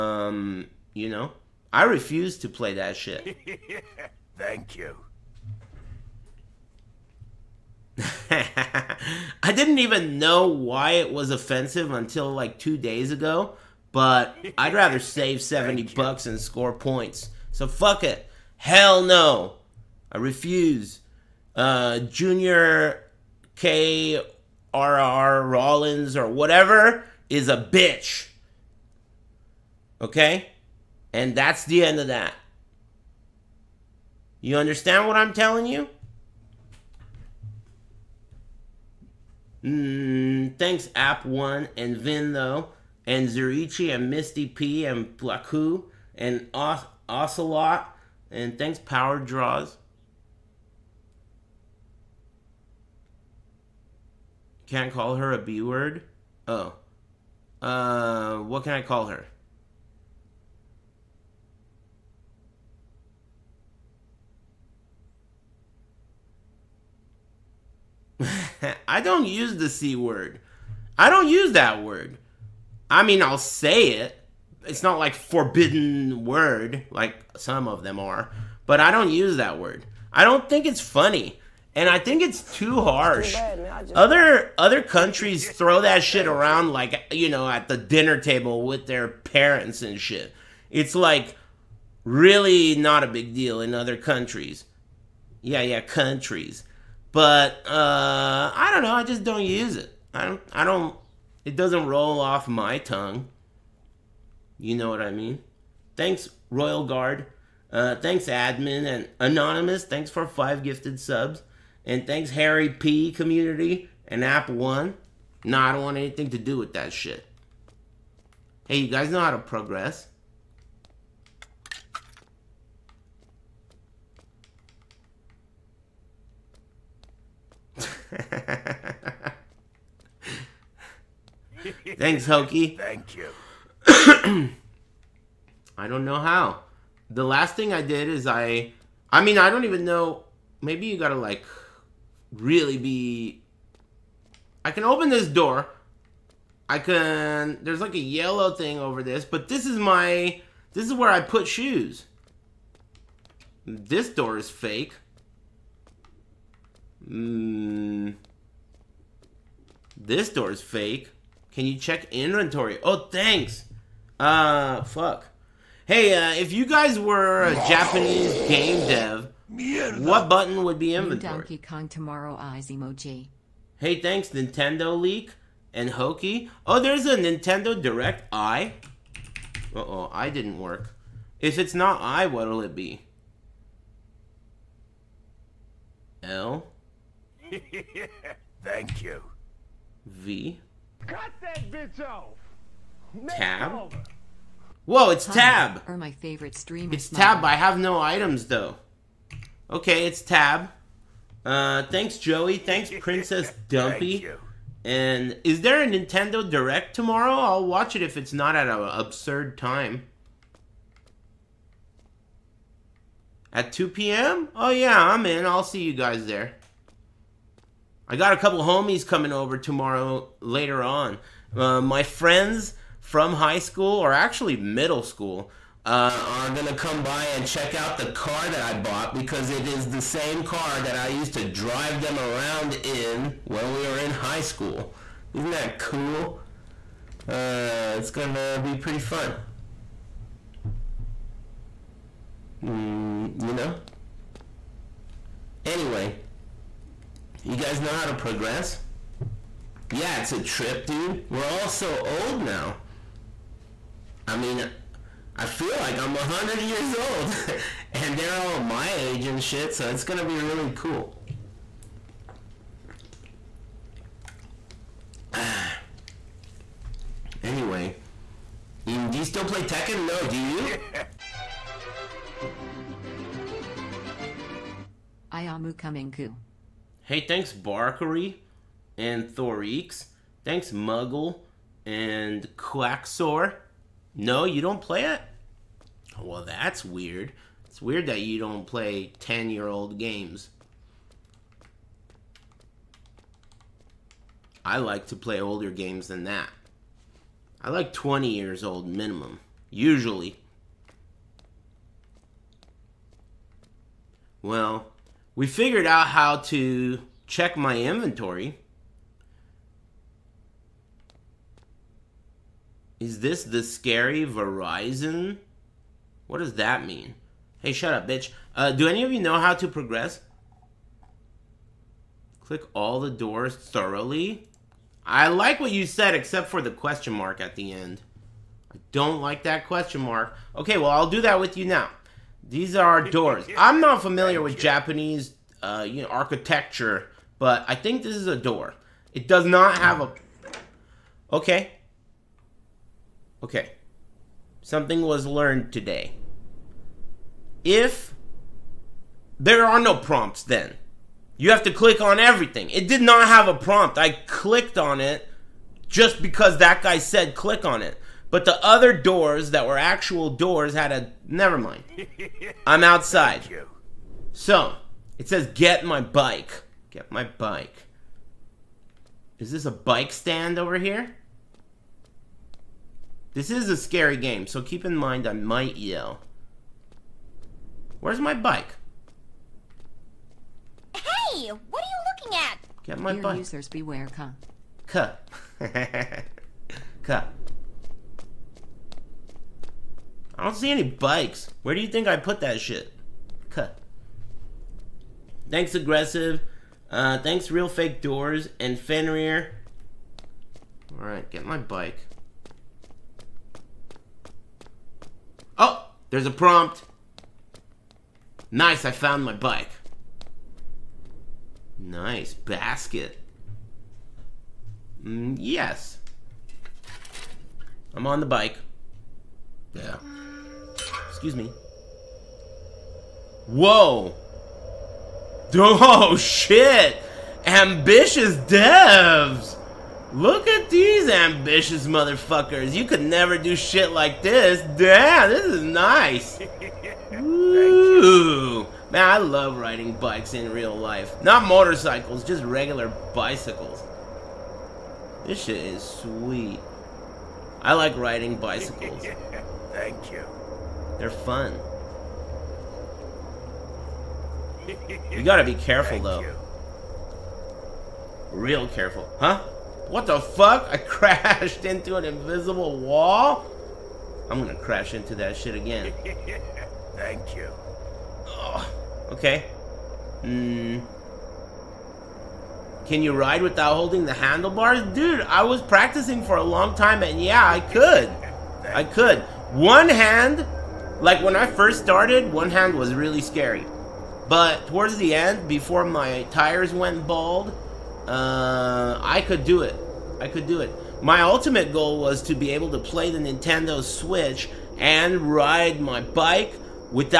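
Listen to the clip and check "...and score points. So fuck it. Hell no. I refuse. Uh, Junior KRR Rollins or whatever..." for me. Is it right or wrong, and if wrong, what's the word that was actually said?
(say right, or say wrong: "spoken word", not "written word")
right.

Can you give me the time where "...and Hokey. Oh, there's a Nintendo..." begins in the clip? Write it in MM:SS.
02:55.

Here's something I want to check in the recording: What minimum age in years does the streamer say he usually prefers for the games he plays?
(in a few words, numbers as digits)
20 years.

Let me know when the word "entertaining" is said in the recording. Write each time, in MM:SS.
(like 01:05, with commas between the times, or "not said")
not said.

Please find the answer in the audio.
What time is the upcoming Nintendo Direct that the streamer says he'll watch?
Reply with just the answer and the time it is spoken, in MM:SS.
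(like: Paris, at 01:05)
2 p.m., at 03:33.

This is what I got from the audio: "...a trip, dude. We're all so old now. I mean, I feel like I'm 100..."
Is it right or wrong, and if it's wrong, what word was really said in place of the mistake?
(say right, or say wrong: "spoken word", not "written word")
right.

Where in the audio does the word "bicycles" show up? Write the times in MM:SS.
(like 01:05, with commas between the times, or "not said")
07:23, 07:28.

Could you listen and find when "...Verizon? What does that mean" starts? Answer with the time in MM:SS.
05:14.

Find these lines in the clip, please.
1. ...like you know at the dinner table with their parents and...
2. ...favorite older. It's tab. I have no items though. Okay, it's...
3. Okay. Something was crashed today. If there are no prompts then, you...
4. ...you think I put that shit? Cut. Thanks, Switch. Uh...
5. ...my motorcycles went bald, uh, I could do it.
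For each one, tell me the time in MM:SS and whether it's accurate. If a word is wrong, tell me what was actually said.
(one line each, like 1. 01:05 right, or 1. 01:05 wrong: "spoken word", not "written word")
1. 01:26 right
2. 03:16 wrong: "streamer", not "older"
3. 05:43 wrong: "learned", not "crashed"
4. 06:31 wrong: "Aggressive", not "Switch"
5. 08:05 wrong: "tires", not "motorcycles".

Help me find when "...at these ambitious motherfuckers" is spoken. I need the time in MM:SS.
07:10.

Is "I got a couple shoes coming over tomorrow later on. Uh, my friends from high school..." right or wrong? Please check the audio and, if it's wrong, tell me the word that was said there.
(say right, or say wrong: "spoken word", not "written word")
wrong: "homies", not "shoes".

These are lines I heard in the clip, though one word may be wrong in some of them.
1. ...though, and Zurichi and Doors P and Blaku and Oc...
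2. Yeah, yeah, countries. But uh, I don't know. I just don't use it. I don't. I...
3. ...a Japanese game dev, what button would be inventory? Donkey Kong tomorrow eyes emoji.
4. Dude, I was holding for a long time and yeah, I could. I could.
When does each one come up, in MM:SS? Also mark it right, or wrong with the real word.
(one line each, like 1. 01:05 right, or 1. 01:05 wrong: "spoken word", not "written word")
1. 00:42 wrong: "Misty", not "Doors"
2. 01:35 right
3. 02:47 right
4. 07:54 wrong: "practicing", not "holding".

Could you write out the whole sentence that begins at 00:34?
You understand what I'm telling you?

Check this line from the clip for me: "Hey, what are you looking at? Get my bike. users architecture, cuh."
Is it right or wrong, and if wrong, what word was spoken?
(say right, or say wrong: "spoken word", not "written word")
wrong: "beware", not "architecture".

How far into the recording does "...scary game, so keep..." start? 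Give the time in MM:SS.
06:13.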